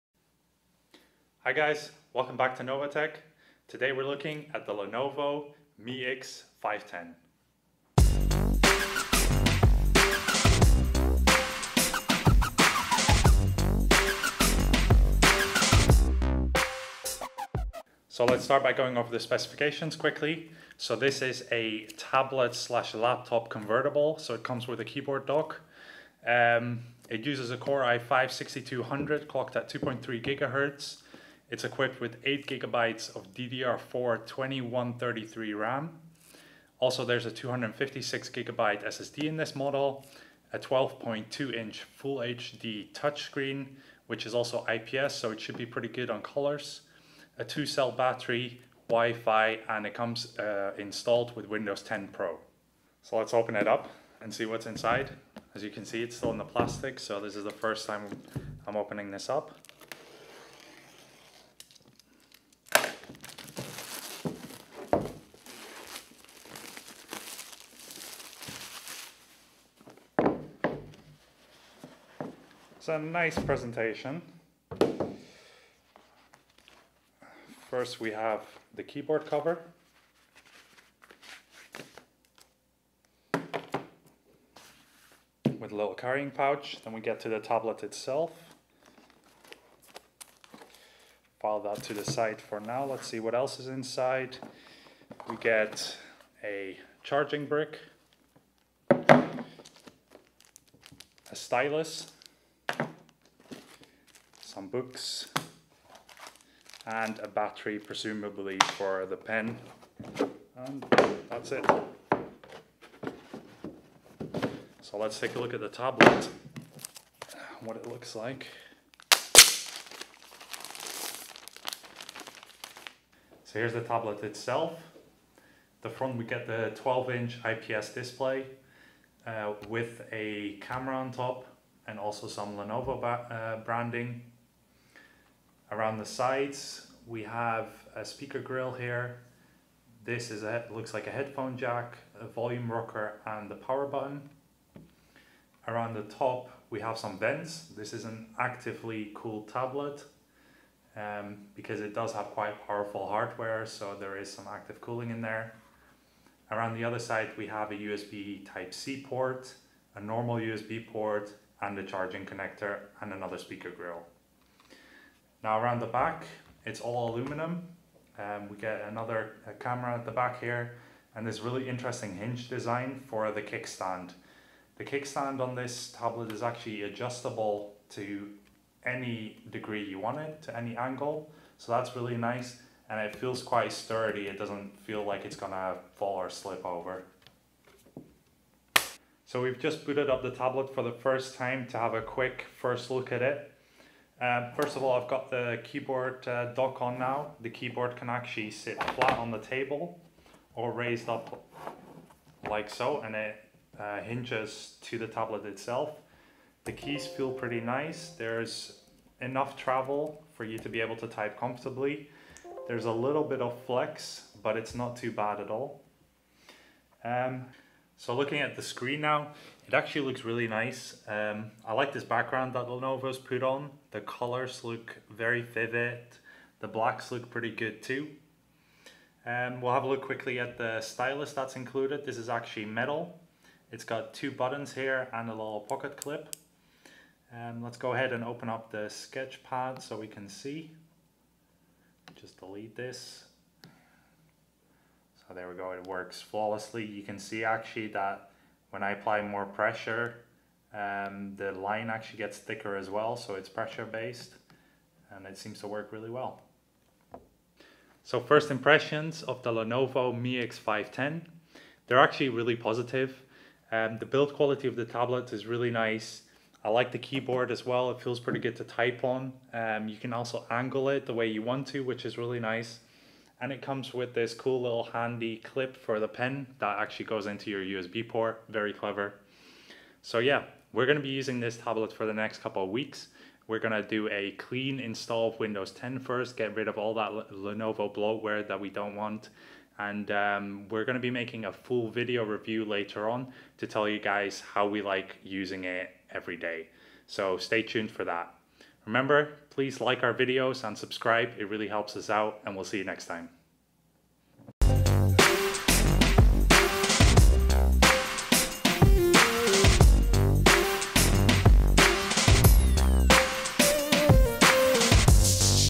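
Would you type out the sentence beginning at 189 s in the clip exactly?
So we've just booted up the tablet for the first time to have a quick first look at it.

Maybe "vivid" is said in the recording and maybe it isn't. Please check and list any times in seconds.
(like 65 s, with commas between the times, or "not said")
225 s.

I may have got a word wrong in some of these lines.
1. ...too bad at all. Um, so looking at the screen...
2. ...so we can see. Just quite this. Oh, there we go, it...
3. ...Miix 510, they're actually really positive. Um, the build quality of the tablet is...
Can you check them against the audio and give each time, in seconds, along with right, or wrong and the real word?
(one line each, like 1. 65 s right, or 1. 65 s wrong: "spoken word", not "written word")
1. 214 s right
2. 239 s wrong: "delete", not "quite"
3. 260 s right.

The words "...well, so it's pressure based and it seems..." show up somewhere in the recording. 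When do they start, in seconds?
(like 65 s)
252 s.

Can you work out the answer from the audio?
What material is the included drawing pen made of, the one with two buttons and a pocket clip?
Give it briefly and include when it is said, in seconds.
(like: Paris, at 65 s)
Metal, at 232 s.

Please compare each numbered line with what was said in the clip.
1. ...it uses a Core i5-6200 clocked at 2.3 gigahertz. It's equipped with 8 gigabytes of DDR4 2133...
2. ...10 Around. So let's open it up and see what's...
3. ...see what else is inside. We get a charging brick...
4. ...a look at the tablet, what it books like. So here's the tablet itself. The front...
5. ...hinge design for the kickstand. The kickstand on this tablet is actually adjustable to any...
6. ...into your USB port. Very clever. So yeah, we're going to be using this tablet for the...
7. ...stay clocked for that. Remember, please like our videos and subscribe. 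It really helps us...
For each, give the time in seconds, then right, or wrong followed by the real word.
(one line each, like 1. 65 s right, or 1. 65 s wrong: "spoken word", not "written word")
1. 27 s right
2. 51 s wrong: "Pro", not "Around"
3. 93 s right
4. 115 s wrong: "looks", not "books"
5. 172 s right
6. 277 s right
7. 297 s wrong: "tuned", not "clocked".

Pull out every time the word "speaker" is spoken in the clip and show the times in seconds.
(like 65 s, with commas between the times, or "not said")
138 s, 163 s.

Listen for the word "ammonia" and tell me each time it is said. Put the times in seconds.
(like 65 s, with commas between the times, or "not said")
not said.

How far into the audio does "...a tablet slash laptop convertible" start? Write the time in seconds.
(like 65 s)
21 s.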